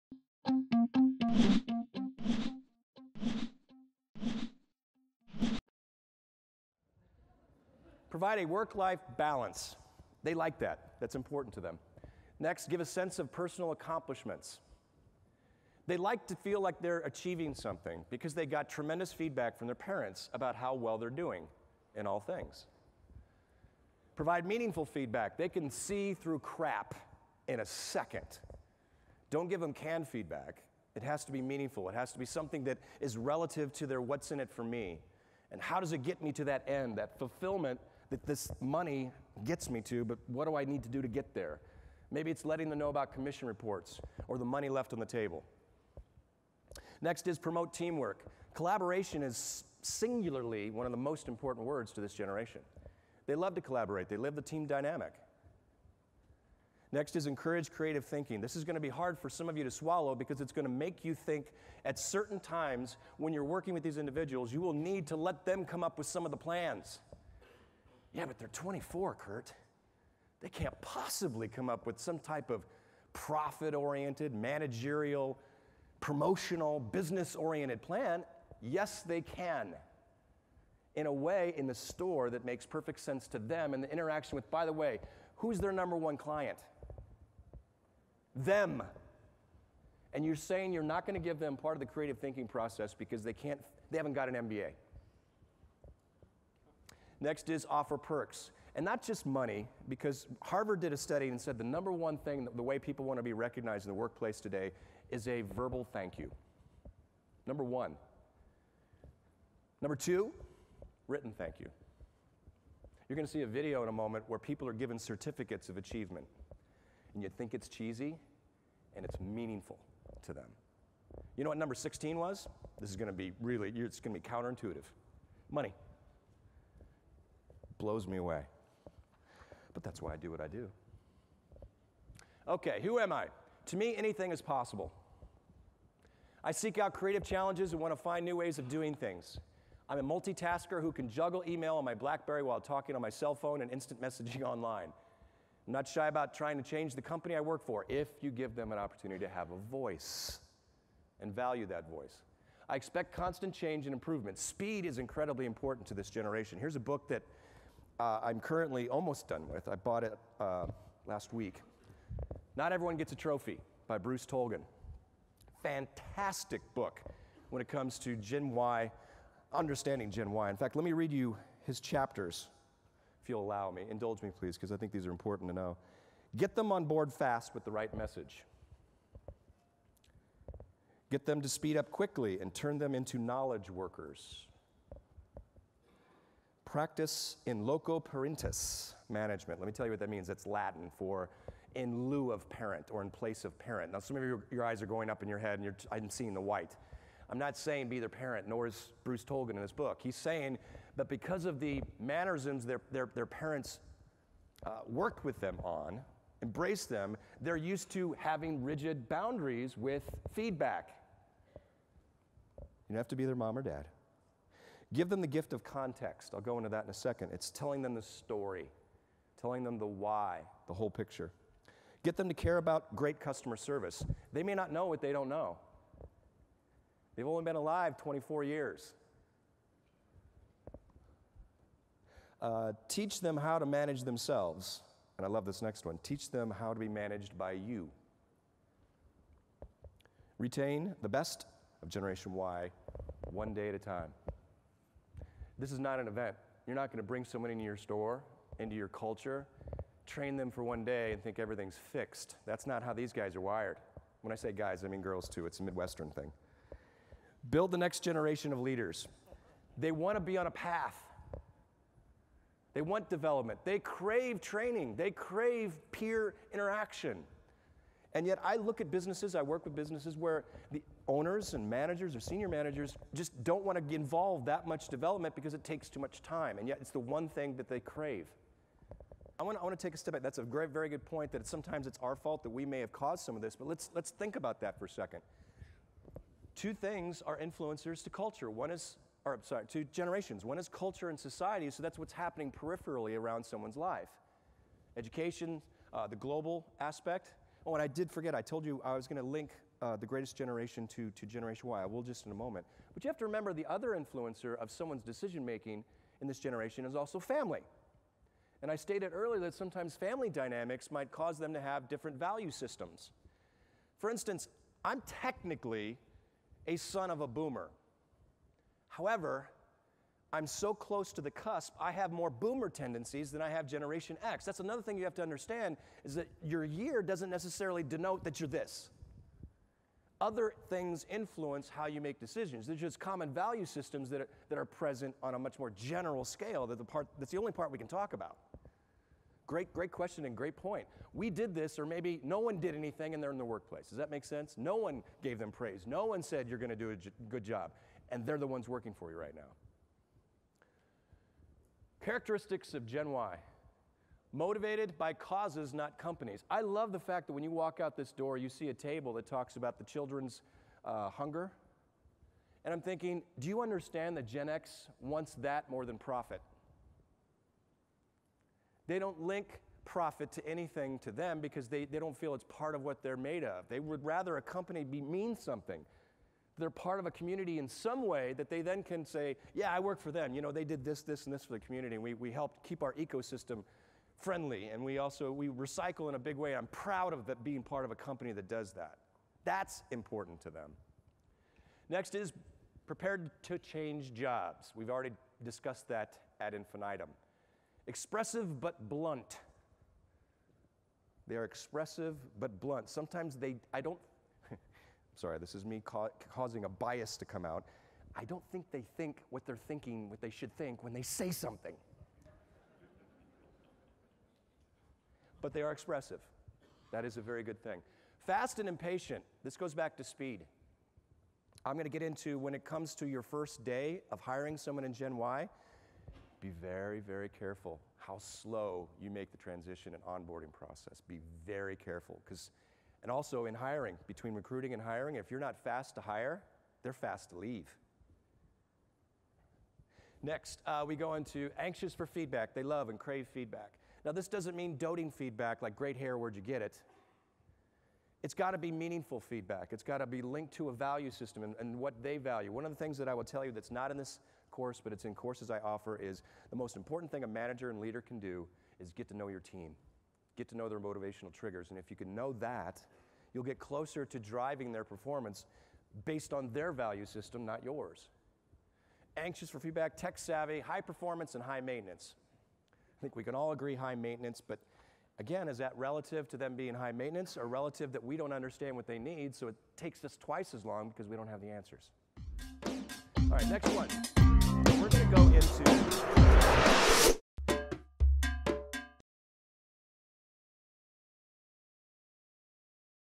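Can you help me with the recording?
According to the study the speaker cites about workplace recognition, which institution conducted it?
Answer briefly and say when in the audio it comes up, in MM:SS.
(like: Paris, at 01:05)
Harvard, at 01:40.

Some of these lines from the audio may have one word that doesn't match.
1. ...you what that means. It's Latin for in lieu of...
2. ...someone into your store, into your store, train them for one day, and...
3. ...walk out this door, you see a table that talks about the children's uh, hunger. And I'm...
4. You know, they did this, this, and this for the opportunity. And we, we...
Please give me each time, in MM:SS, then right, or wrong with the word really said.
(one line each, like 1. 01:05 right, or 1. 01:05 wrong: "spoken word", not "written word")
1. 03:09 right
2. 04:07 wrong: "culture", not "store"
3. 05:57 right
4. 06:20 wrong: "community", not "opportunity".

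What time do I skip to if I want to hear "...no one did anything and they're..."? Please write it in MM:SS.
05:42.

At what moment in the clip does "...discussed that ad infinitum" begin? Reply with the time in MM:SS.
06:35.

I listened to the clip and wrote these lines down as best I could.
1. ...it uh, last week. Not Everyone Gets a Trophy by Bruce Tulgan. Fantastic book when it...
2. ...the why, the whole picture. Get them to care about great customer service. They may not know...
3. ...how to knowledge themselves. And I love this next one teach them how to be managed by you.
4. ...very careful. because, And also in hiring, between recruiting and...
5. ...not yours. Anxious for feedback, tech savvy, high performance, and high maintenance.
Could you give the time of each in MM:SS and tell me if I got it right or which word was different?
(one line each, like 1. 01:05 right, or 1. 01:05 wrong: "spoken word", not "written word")
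1. 02:40 right
2. 03:39 right
3. 03:53 wrong: "manage", not "knowledge"
4. 07:11 right
5. 07:47 right.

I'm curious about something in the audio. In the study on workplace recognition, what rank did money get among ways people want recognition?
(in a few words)
16.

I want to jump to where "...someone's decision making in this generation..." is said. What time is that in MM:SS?
05:04.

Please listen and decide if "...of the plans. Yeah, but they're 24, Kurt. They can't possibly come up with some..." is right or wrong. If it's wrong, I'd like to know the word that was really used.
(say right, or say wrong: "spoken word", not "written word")
right.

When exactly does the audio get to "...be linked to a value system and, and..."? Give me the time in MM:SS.
07:30.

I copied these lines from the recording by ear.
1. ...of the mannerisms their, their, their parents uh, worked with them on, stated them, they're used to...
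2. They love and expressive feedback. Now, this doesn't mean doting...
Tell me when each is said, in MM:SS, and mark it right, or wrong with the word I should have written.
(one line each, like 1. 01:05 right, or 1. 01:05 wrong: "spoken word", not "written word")
1. 03:21 wrong: "embraced", not "stated"
2. 07:22 wrong: "crave", not "expressive".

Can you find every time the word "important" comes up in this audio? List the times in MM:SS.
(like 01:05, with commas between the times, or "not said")
00:11, 00:51, 02:35, 02:55, 06:29, 07:36.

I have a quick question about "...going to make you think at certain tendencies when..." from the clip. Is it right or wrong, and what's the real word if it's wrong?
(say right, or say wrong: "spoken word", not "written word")
wrong: "times", not "tendencies".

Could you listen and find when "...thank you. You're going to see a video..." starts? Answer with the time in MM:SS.
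01:51.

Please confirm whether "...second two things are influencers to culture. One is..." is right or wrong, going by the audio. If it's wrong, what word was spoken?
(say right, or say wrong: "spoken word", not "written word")
right.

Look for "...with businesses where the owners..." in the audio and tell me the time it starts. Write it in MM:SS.
04:29.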